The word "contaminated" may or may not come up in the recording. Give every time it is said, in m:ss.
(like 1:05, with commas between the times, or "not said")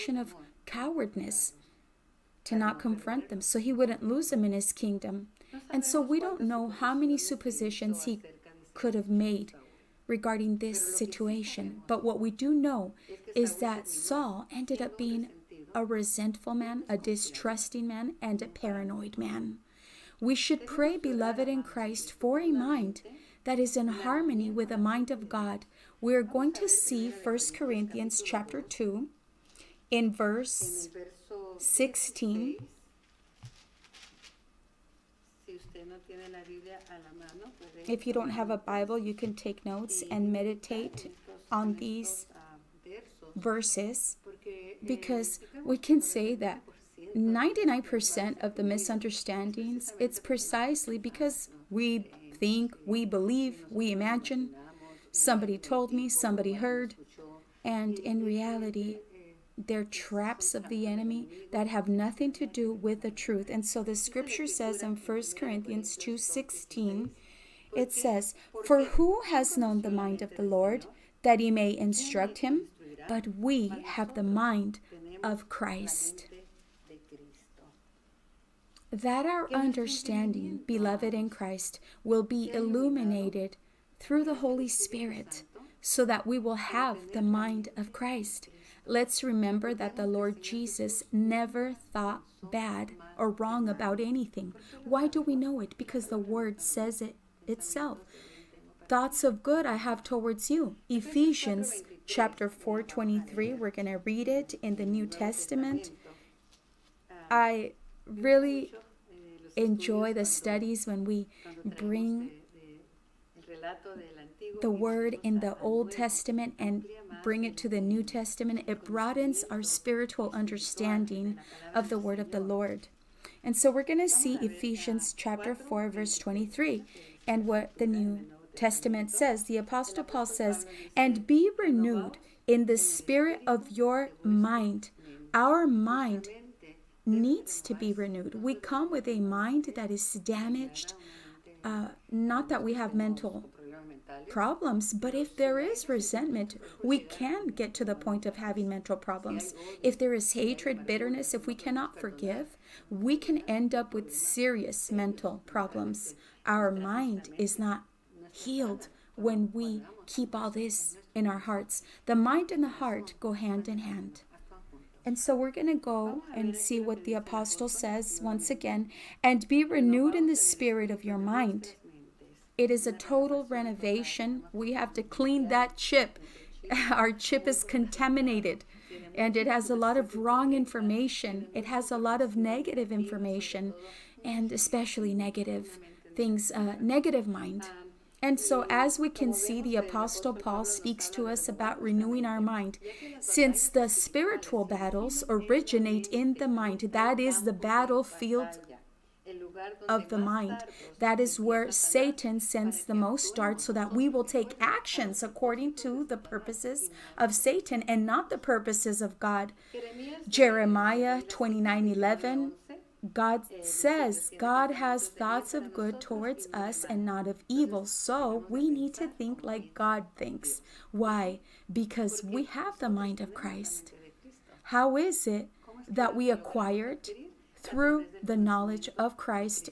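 2:57.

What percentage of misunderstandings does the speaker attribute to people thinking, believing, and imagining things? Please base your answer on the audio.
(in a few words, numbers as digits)
99%.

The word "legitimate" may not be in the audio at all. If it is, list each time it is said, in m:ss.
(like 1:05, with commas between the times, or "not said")
not said.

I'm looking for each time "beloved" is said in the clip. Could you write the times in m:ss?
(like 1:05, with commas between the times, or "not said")
0:20, 1:20.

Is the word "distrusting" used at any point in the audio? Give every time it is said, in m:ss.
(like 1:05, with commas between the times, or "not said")
0:16.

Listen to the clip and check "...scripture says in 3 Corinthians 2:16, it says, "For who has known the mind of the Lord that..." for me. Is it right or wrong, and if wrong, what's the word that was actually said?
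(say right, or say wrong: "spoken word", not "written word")
wrong: "1", not "3".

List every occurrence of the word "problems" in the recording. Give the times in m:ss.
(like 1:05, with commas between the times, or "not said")
2:24, 2:28, 2:35.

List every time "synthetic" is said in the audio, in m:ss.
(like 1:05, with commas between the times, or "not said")
not said.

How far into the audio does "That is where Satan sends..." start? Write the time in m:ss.
3:20.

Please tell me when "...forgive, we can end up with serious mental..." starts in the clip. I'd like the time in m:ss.
2:31.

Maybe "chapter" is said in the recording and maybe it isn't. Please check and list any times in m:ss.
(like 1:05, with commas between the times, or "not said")
0:28, 1:42, 2:05.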